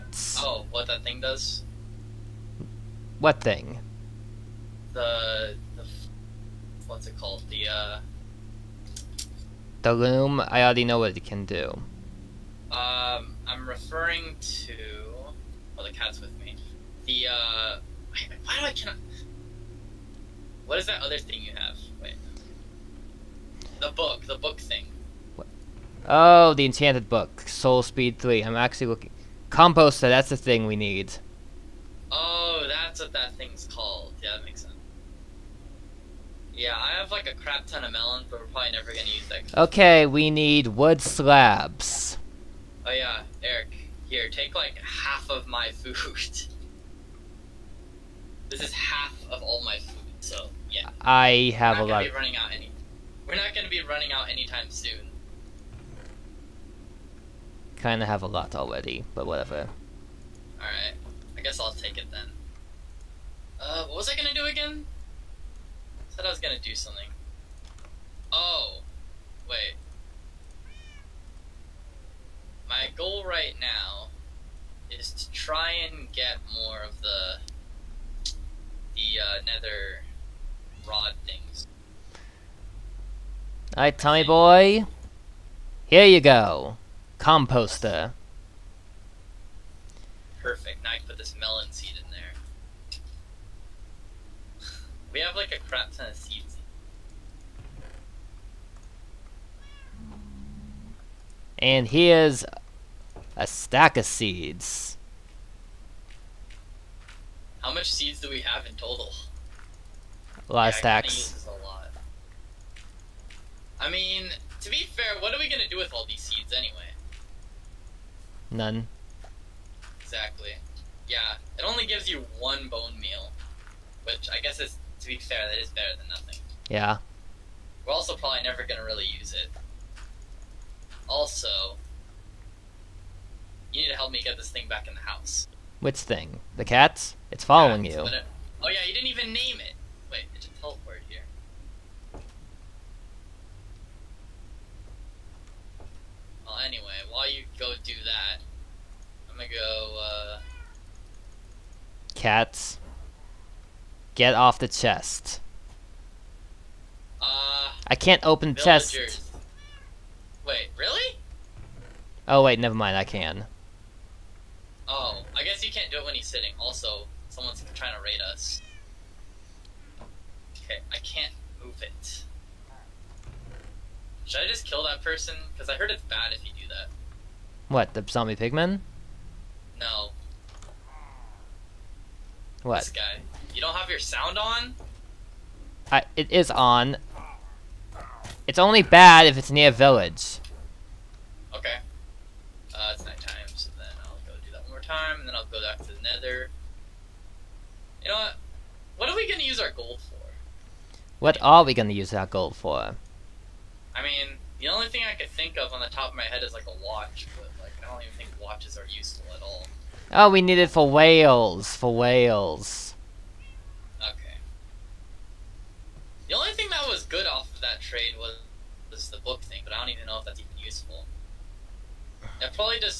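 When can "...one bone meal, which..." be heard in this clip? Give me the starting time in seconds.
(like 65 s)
122 s.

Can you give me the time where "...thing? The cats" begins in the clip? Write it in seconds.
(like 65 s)
135 s.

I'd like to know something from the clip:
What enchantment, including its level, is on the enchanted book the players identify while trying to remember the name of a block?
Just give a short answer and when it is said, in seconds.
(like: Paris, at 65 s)
Soul Speed 3, at 27 s.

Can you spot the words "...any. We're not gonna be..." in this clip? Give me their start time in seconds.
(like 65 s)
52 s.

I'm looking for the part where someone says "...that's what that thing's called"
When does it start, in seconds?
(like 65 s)
32 s.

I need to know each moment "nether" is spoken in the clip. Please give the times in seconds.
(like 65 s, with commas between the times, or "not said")
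79 s, 196 s.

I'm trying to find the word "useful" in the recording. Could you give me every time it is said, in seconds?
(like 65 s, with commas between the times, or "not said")
208 s, 220 s.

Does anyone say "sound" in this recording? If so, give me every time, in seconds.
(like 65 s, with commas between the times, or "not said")
183 s.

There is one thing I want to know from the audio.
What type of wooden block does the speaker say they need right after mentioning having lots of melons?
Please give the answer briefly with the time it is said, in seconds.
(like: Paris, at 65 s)
wood slabs, at 40 s.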